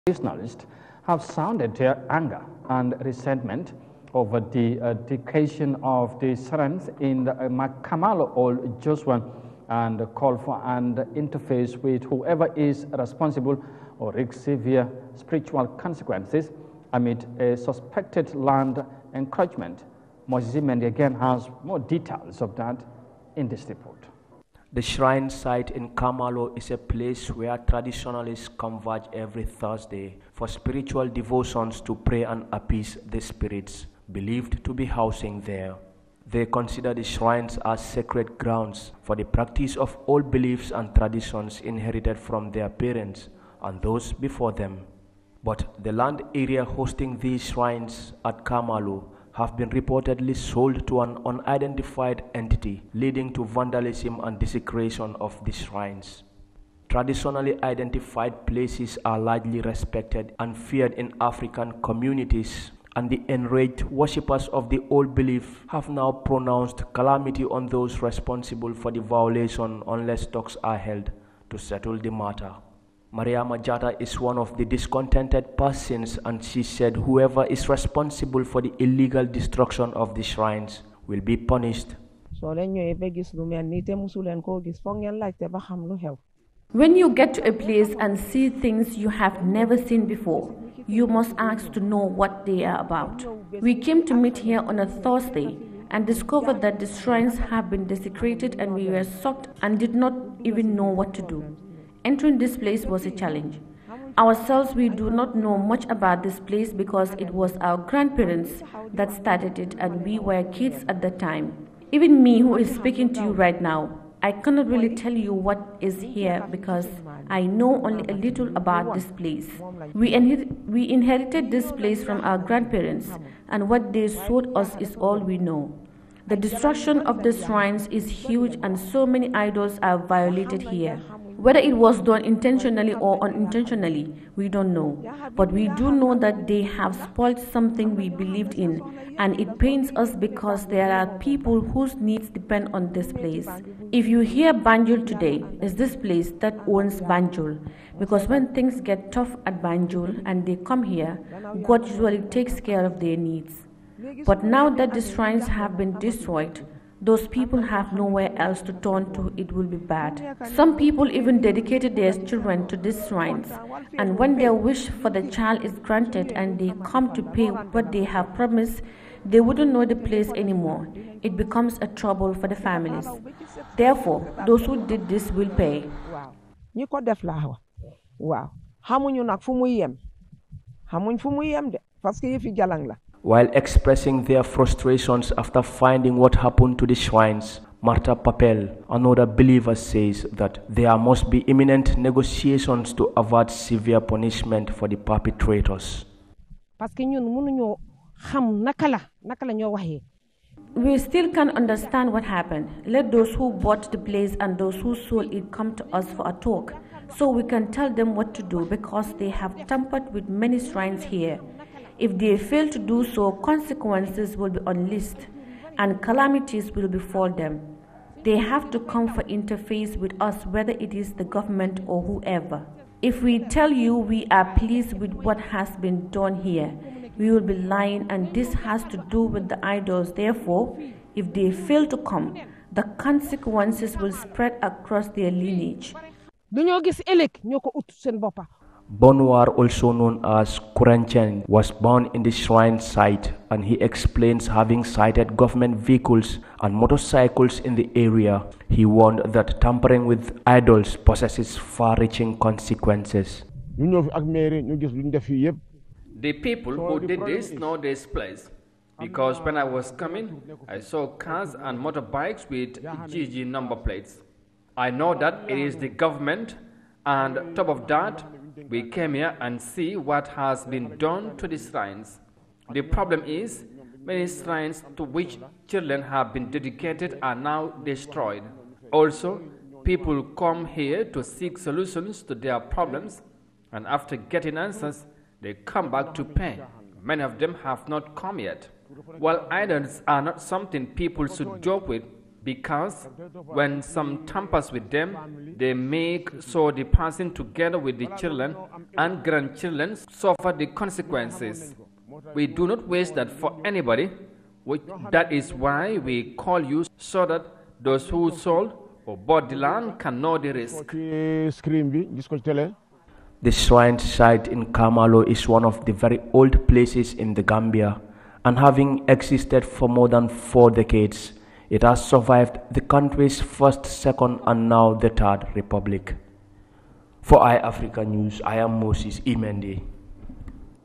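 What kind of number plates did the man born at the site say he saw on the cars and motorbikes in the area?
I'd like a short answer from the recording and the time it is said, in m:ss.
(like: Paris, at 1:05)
GG, at 4:22.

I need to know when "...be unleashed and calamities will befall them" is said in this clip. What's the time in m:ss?
3:34.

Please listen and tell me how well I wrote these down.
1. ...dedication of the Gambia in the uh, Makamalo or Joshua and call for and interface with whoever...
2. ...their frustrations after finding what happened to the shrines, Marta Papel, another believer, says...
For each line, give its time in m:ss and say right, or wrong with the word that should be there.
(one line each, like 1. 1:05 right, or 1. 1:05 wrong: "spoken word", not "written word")
1. 0:04 wrong: "Sarans", not "Gambia"
2. 3:04 right.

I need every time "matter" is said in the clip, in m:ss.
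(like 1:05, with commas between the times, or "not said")
1:12.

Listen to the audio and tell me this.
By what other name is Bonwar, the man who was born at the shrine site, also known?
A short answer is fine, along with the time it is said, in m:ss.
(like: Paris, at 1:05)
Kurenchen, at 4:00.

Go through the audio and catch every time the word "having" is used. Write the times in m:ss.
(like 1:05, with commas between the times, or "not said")
4:04, 5:18.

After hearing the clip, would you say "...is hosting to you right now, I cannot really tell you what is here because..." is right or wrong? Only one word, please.
wrong.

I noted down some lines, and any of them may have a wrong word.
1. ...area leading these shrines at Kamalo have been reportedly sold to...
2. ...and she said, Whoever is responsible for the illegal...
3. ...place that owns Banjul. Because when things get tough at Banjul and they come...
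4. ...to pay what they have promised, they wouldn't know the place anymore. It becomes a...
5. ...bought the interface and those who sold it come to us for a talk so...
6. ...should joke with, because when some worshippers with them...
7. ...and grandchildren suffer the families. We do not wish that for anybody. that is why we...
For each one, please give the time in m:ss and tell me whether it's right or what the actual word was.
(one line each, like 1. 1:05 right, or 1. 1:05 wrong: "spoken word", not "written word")
1. 0:46 wrong: "hosting", not "leading"
2. 1:16 right
3. 2:25 right
4. 2:47 right
5. 3:23 wrong: "place", not "interface"
6. 4:51 wrong: "tampers", not "worshippers"
7. 4:58 wrong: "consequences", not "families".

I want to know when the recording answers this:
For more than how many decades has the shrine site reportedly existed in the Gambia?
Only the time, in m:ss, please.
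5:20.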